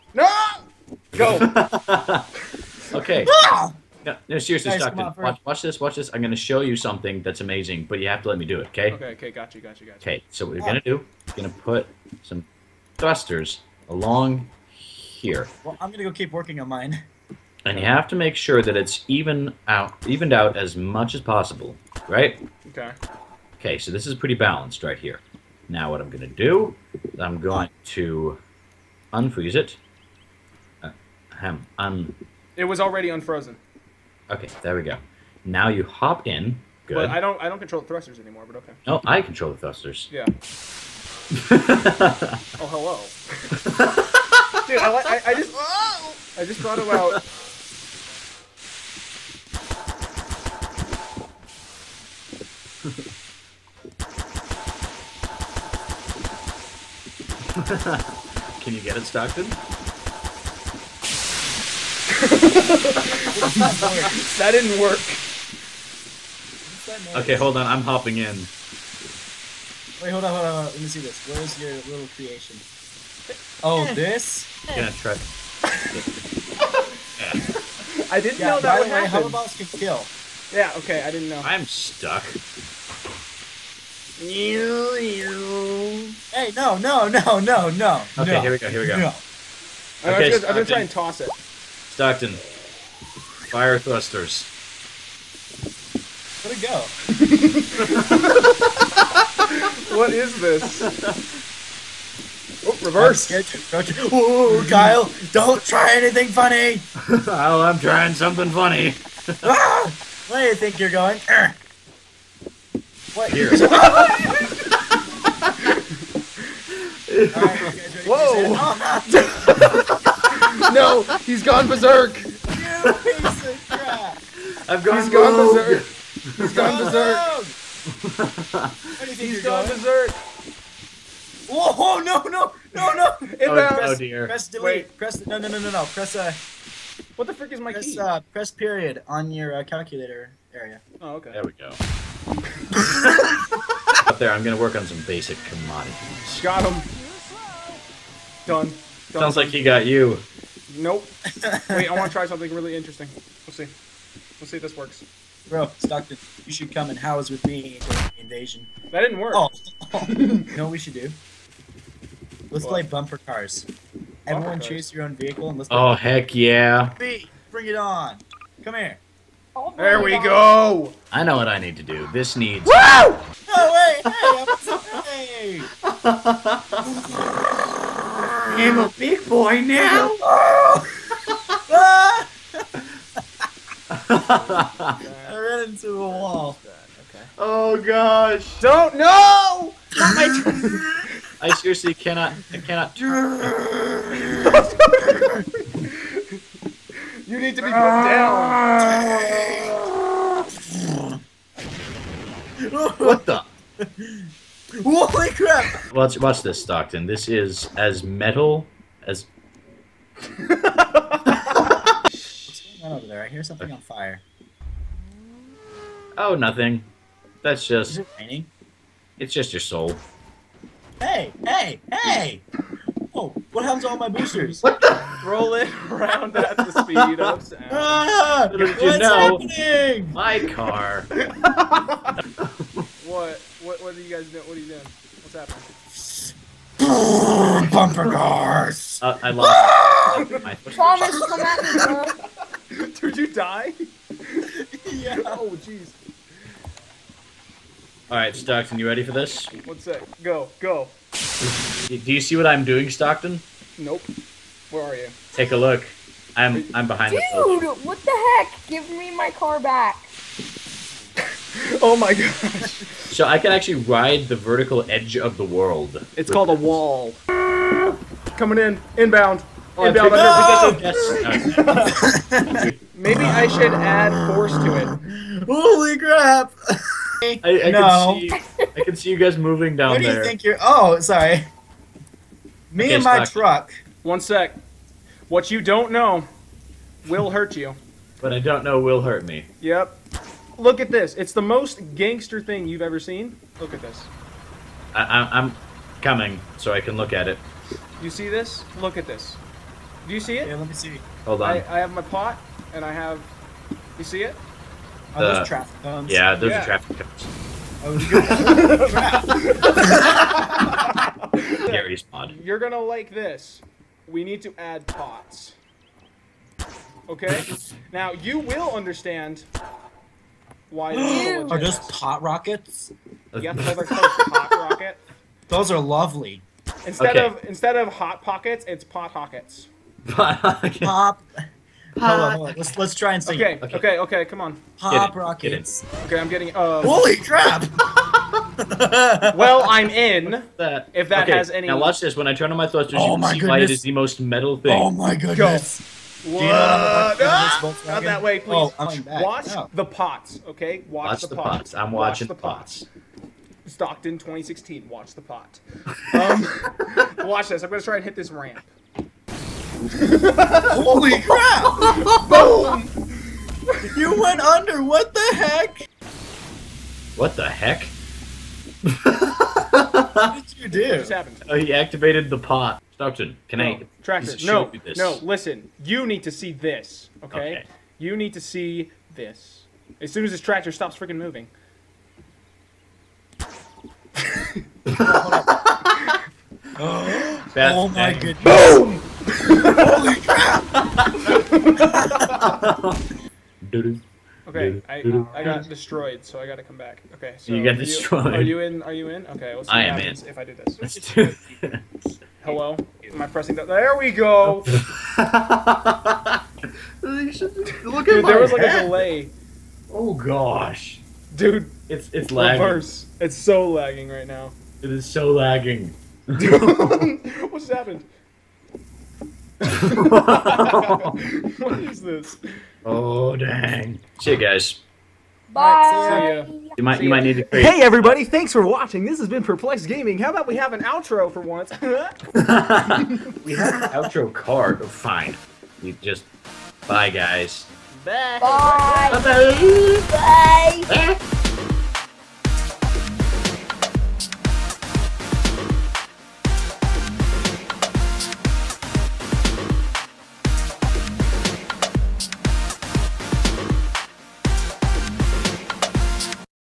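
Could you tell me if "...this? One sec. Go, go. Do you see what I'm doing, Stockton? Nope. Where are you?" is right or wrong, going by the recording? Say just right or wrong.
right.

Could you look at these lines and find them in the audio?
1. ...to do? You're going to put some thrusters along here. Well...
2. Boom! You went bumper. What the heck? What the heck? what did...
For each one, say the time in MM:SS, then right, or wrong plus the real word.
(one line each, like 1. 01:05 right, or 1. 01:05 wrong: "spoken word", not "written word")
1. 00:10 right
2. 06:02 wrong: "under", not "bumper".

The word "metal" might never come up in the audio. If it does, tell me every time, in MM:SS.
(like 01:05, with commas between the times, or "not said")
03:28, 05:44.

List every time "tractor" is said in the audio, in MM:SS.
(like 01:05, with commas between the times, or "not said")
06:14, 06:20.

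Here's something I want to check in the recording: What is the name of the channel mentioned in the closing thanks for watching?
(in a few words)
Perplexed Gaming.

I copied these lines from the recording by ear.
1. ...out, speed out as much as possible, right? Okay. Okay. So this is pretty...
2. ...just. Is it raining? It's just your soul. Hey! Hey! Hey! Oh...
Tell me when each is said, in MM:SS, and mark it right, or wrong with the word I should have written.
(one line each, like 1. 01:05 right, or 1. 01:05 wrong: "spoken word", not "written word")
1. 00:19 wrong: "evened", not "speed"
2. 03:37 right.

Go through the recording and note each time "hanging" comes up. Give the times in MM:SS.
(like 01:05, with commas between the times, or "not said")
not said.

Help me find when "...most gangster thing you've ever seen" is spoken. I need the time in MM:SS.
04:51.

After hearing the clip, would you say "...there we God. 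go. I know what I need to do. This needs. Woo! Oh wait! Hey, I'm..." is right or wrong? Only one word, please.
right.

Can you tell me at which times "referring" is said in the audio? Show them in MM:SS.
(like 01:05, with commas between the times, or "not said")
not said.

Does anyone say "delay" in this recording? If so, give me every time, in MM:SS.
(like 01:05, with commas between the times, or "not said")
06:48.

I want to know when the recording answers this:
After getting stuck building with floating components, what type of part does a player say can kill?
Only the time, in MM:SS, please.
01:19.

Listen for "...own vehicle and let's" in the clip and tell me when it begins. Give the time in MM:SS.
02:45.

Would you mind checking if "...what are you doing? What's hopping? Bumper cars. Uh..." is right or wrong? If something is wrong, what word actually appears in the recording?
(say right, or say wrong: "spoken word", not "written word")
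wrong: "happening", not "hopping".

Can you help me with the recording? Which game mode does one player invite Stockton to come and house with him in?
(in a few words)
Invasion.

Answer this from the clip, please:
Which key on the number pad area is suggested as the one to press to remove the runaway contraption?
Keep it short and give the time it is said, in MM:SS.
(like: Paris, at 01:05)
Period, at 02:18.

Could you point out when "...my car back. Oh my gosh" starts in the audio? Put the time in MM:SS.
04:19.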